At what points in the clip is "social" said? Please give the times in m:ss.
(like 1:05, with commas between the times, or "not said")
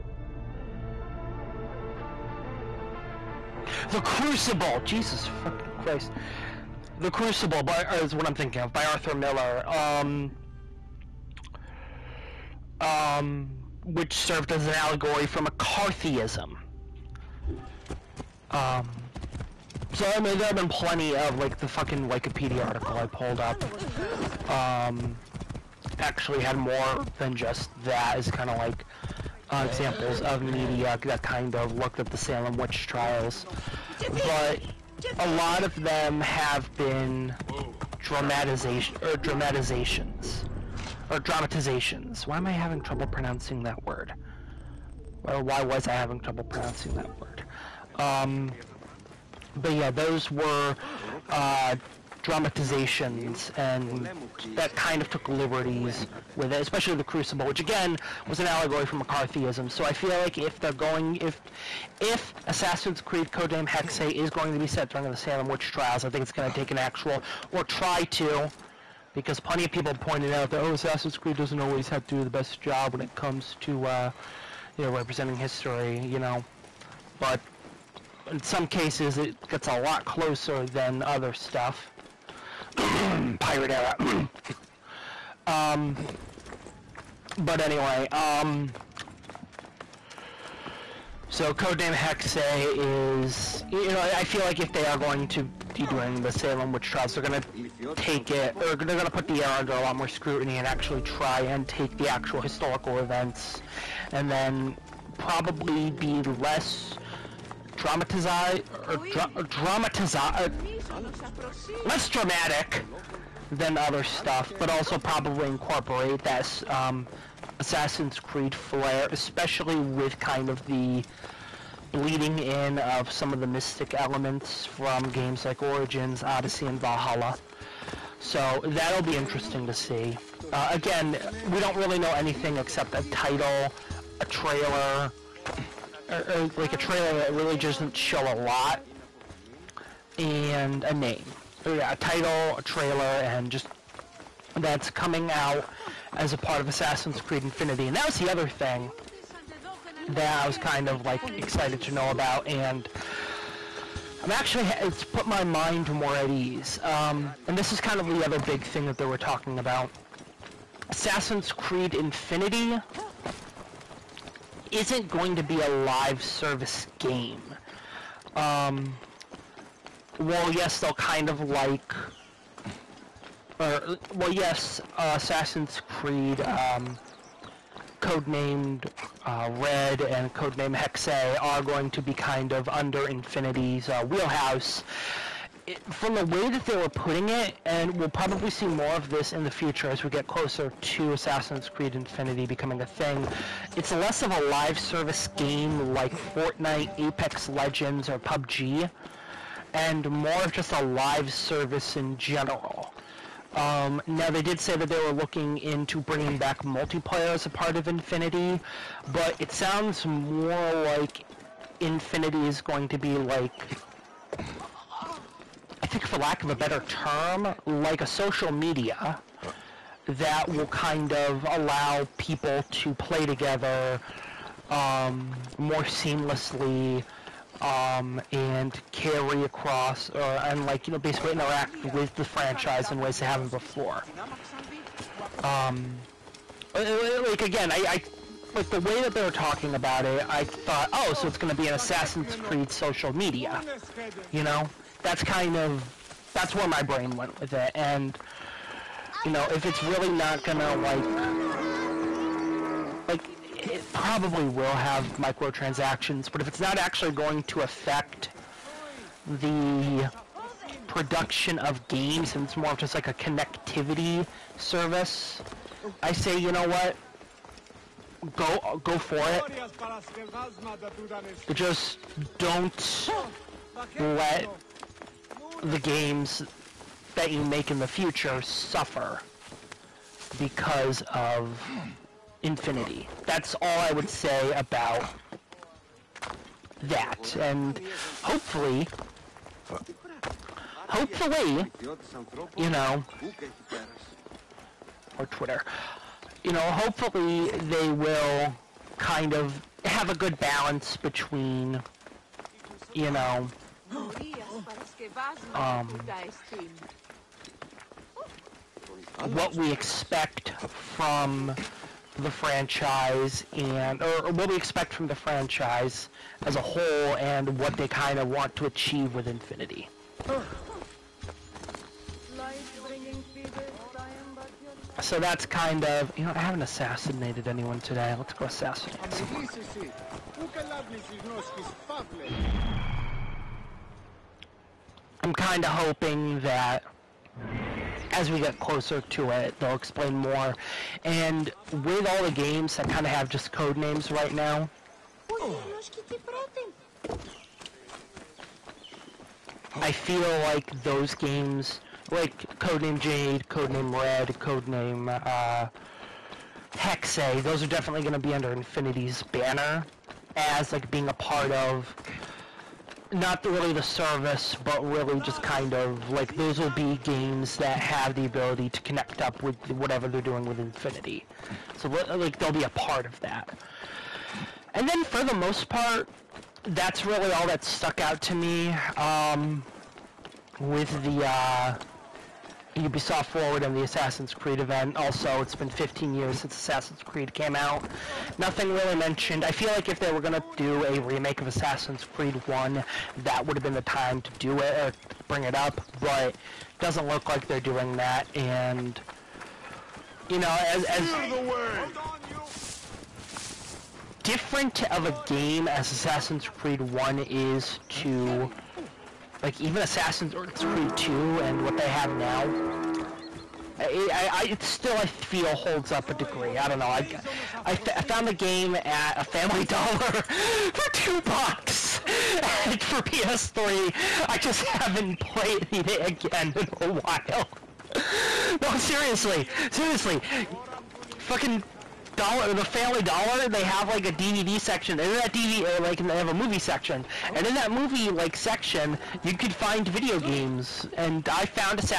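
3:38, 4:02.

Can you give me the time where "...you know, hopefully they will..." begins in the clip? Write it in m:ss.
4:56.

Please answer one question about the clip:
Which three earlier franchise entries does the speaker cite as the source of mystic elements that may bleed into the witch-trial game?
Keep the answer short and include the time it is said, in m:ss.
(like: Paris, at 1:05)
Origins, Odyssey, and Valhalla, at 2:05.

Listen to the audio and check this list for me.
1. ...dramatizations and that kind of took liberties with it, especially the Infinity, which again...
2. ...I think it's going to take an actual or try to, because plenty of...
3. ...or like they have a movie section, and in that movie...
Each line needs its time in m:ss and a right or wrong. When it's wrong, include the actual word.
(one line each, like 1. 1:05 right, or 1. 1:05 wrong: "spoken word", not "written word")
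1. 0:52 wrong: "Crucible", not "Infinity"
2. 1:06 right
3. 7:15 right.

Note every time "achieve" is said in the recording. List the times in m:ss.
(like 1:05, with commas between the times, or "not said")
5:18.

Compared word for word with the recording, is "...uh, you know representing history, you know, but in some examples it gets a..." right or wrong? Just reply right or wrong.
wrong.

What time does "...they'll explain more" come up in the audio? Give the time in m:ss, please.
5:39.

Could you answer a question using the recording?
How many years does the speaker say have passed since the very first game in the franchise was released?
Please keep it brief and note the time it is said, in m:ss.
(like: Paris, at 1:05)
15, at 6:25.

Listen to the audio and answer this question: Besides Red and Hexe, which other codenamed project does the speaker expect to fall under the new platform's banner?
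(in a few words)
Codename Jade.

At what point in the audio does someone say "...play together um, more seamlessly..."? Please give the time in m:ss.
3:42.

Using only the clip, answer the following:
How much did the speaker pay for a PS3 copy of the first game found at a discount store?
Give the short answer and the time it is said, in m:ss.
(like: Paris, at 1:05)
2 dollars, at 7:00.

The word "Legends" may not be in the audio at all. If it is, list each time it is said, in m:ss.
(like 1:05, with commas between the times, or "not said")
3:17.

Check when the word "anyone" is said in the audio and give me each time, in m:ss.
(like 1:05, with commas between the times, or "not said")
5:27.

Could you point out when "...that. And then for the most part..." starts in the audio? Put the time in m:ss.
6:13.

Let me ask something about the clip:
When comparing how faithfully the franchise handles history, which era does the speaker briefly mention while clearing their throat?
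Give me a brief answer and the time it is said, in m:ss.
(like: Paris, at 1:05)
pirate era, at 1:23.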